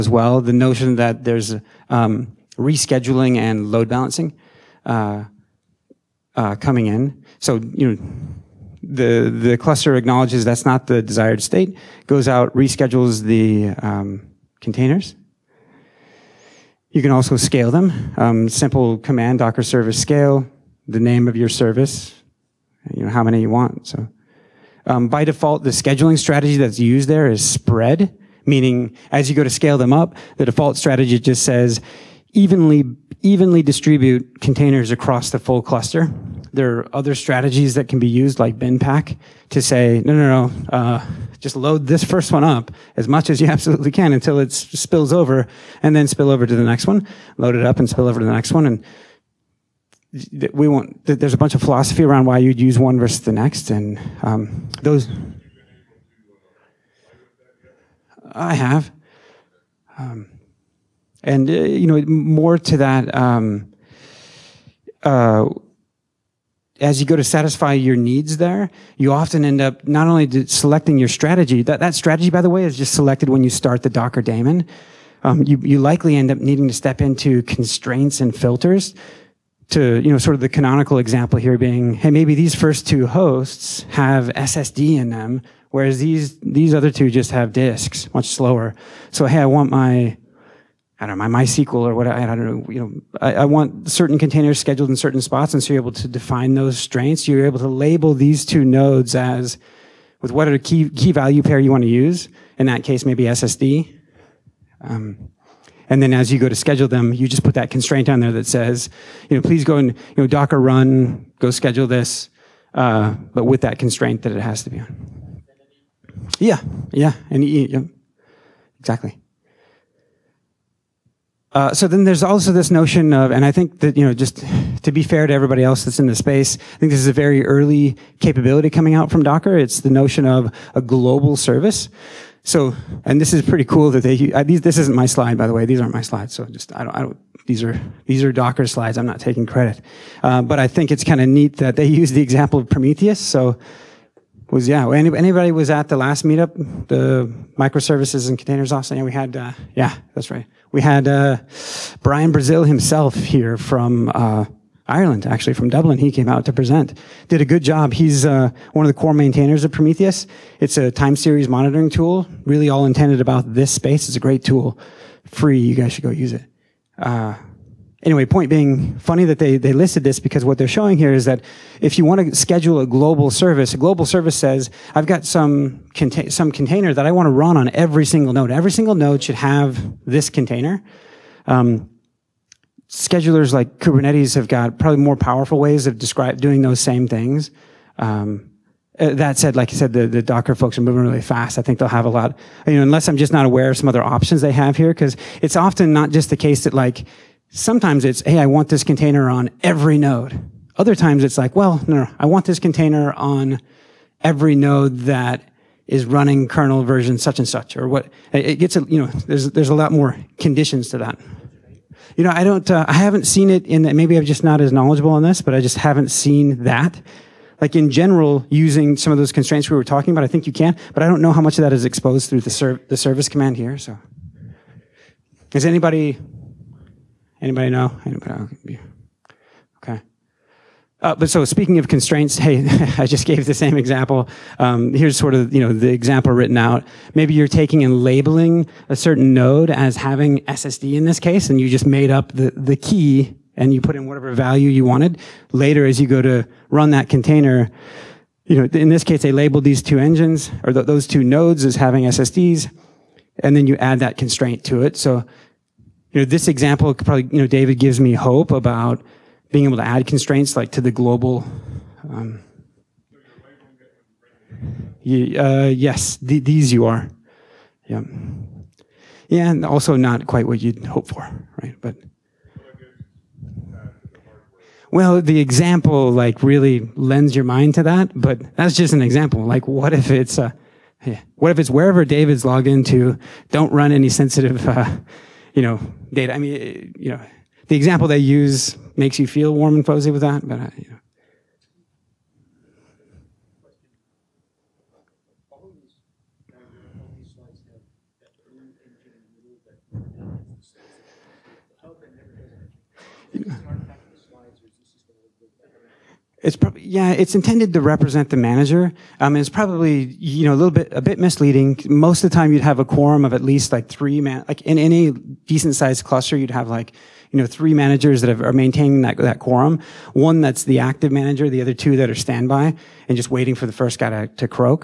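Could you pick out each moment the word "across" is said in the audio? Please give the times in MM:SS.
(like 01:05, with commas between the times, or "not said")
00:34.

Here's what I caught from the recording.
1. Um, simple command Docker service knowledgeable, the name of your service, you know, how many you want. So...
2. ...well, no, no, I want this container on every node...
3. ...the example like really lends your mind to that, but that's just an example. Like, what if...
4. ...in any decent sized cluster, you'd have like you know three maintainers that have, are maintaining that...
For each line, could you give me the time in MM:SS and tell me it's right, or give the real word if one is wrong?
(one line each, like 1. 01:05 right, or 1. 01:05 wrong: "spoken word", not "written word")
1. 00:18 wrong: "scale", not "knowledgeable"
2. 03:21 right
3. 04:35 right
4. 05:14 wrong: "managers", not "maintainers".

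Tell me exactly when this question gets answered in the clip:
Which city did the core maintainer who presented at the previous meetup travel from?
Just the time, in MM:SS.
02:35.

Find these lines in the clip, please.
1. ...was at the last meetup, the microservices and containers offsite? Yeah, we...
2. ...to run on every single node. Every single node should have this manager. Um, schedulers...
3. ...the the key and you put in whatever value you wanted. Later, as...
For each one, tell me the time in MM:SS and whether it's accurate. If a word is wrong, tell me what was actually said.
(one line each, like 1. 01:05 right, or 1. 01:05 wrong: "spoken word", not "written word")
1. 02:25 right
2. 02:57 wrong: "container", not "manager"
3. 04:02 right.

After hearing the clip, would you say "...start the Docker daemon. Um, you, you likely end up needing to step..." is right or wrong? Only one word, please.
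right.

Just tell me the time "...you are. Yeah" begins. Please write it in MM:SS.
04:26.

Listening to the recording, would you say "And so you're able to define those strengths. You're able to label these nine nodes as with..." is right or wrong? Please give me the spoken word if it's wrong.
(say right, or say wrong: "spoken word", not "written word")
wrong: "two", not "nine".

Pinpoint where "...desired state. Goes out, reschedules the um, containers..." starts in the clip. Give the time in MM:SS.
00:11.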